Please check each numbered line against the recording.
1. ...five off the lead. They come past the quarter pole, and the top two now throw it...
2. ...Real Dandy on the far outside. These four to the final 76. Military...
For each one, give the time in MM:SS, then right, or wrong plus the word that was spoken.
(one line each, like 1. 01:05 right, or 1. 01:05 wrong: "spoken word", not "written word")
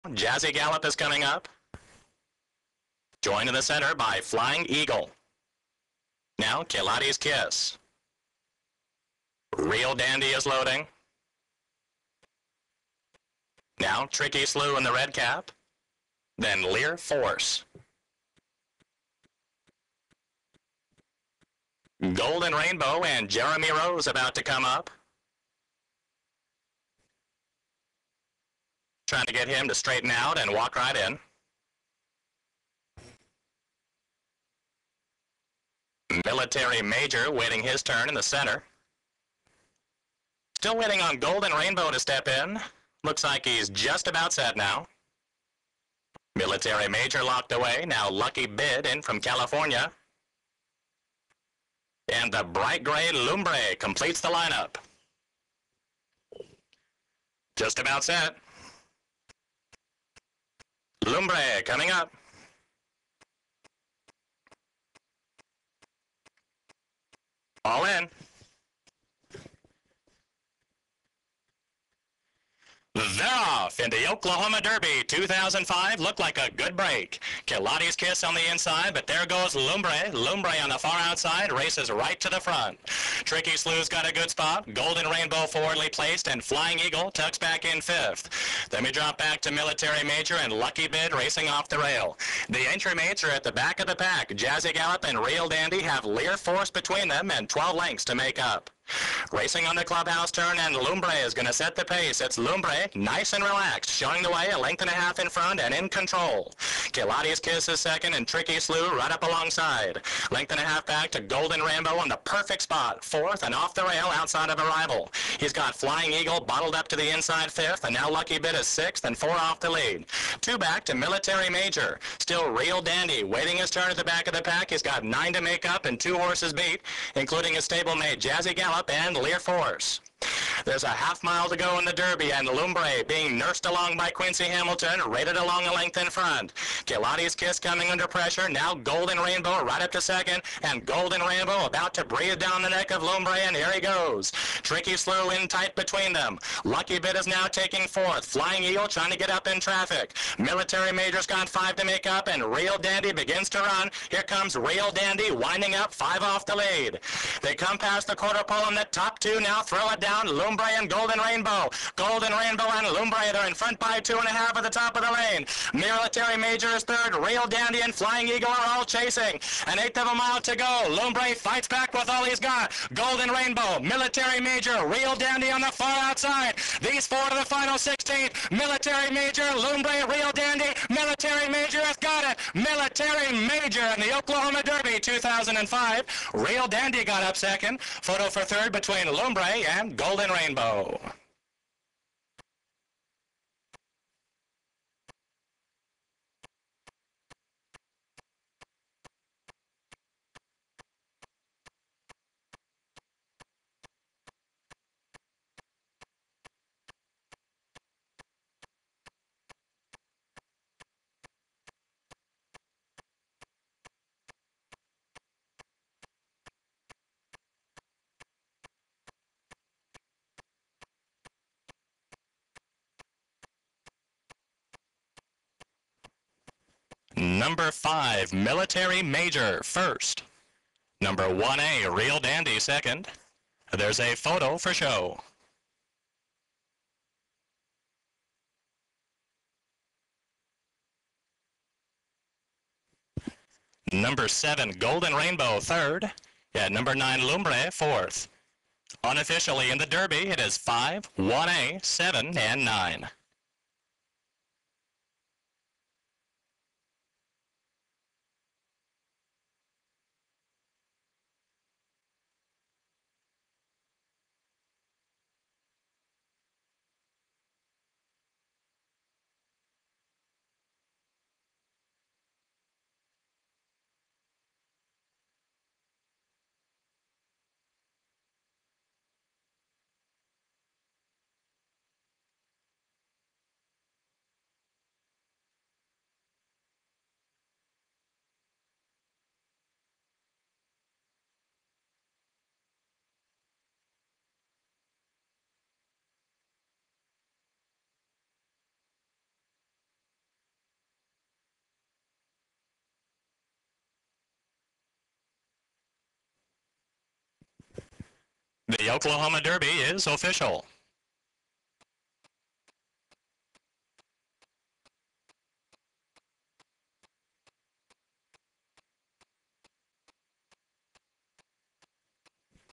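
1. 02:35 right
2. 02:54 wrong: "16", not "76".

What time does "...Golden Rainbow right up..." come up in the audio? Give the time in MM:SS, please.
02:18.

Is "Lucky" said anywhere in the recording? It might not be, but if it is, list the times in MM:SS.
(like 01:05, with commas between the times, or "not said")
00:48, 01:30, 01:58, 02:26.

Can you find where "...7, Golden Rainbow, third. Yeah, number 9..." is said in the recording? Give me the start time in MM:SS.
04:04.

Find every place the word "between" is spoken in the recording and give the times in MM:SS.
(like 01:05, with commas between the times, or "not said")
01:36, 02:25, 03:08.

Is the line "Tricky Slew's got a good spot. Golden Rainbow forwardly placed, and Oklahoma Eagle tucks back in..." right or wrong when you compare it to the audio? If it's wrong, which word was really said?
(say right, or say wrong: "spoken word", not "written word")
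wrong: "Flying", not "Oklahoma".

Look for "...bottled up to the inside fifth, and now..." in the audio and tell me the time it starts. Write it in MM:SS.
01:56.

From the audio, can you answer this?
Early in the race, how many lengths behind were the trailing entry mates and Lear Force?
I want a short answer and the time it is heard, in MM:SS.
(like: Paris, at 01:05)
12, at 01:37.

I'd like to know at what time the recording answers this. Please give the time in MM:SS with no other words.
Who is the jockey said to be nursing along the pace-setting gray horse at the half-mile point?
02:14.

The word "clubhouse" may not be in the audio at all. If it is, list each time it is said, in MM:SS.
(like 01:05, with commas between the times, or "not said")
01:39.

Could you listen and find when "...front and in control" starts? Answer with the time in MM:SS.
01:45.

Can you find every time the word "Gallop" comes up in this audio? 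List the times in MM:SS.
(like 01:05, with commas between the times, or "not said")
00:00, 01:34, 02:08.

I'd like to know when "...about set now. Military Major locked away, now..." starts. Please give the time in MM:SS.
00:44.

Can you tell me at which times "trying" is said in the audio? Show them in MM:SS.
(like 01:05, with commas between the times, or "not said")
00:29, 02:28.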